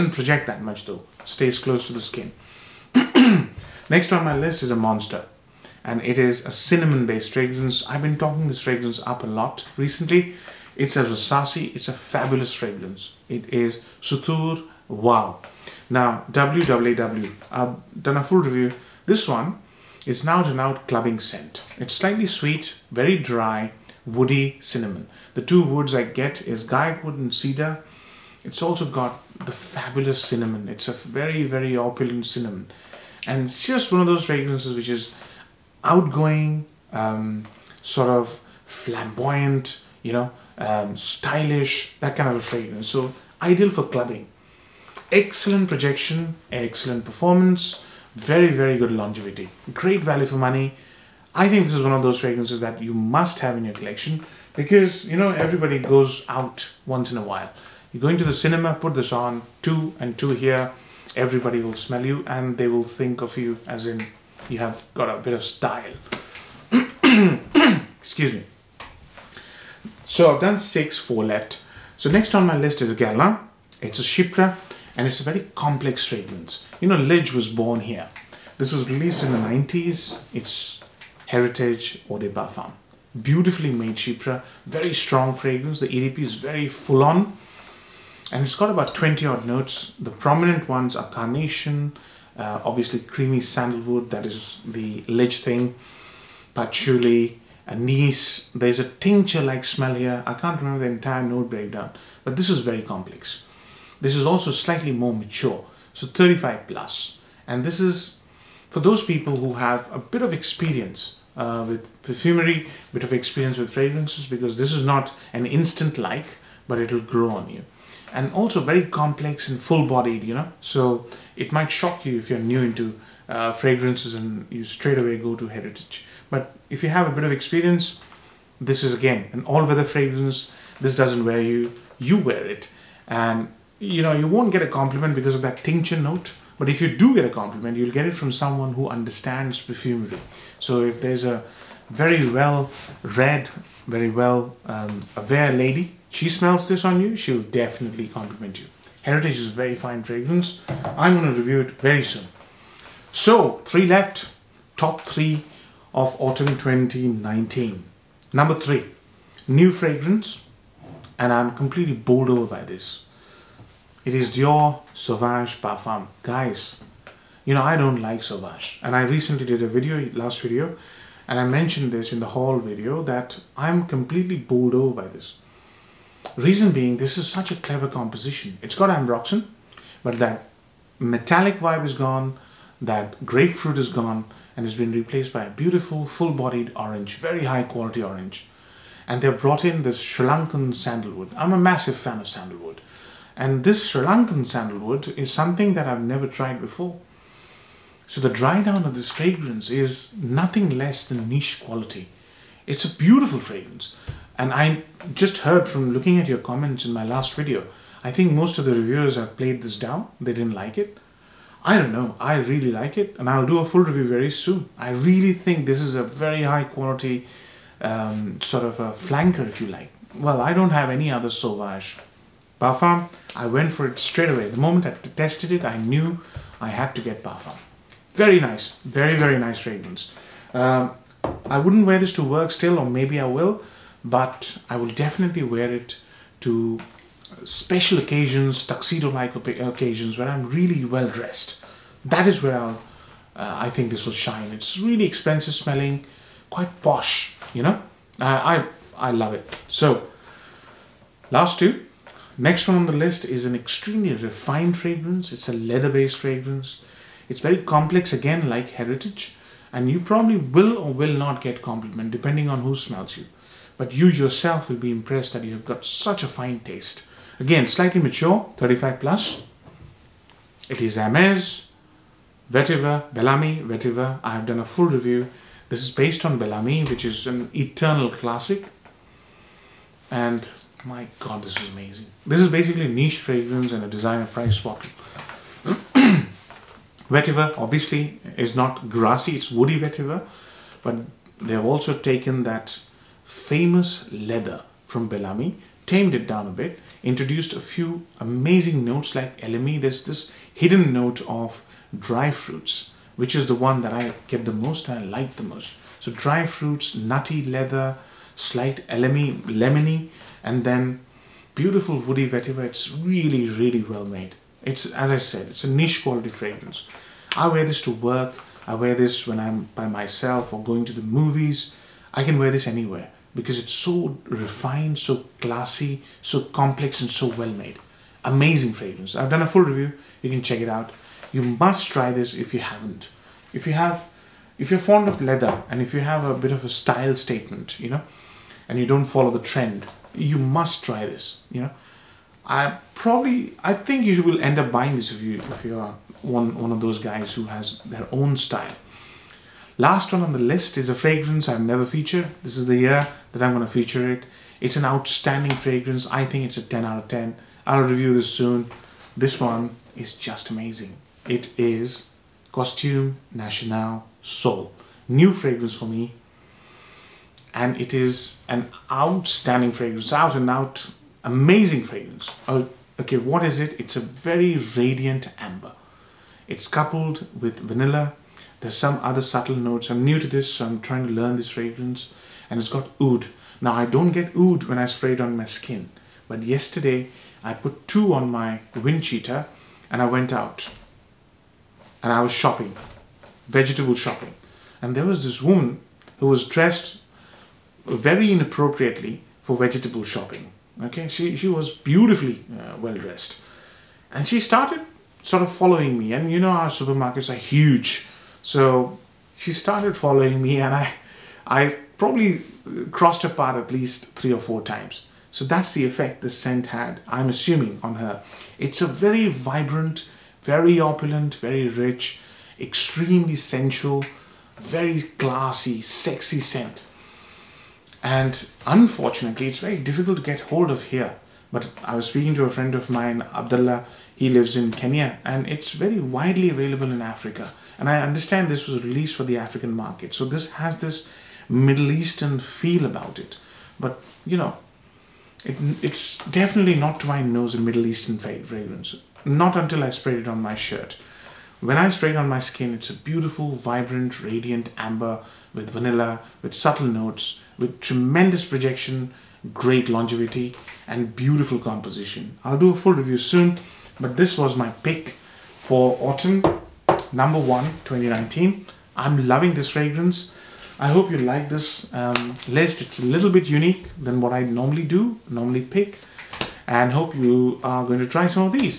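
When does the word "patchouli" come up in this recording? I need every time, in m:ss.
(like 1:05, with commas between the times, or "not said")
1:36.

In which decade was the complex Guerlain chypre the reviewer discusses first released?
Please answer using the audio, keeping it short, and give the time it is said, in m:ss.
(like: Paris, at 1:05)
the 90s, at 1:19.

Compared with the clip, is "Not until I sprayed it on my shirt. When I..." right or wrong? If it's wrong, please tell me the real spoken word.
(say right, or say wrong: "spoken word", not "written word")
right.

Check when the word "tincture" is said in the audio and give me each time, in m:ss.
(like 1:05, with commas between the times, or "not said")
1:38, 2:15.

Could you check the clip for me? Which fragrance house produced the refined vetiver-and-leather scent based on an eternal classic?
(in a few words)
Hermes.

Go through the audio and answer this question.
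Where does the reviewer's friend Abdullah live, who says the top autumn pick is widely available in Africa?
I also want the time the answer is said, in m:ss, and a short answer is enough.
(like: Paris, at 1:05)
Kenya, at 7:14.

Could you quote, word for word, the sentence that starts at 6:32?
And I was shopping, vegetable shopping.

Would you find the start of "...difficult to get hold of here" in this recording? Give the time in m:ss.
7:09.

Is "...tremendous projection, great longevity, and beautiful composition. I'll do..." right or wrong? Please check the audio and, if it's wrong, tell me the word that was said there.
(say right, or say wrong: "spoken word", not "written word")
right.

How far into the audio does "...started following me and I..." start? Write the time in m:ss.
6:49.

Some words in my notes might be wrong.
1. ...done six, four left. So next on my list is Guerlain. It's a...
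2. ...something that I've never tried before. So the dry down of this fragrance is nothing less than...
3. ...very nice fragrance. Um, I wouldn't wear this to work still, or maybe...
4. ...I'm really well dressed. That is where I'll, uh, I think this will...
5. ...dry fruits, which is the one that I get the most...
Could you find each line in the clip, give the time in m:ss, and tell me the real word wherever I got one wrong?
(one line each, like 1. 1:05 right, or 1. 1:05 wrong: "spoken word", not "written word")
1. 1:10 right
2. 3:15 right
3. 3:49 right
4. 4:00 right
5. 5:01 right.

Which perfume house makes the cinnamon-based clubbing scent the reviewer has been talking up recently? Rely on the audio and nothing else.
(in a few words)
Rasasi.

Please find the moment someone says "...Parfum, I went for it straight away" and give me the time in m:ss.
3:42.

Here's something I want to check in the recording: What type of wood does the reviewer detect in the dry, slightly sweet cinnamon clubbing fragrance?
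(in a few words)
cedar.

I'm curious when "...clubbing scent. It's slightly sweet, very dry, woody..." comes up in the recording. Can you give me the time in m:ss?
0:20.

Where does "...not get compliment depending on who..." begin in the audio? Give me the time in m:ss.
4:21.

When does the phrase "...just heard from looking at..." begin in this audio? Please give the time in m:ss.
3:25.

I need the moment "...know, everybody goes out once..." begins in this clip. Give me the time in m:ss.
0:55.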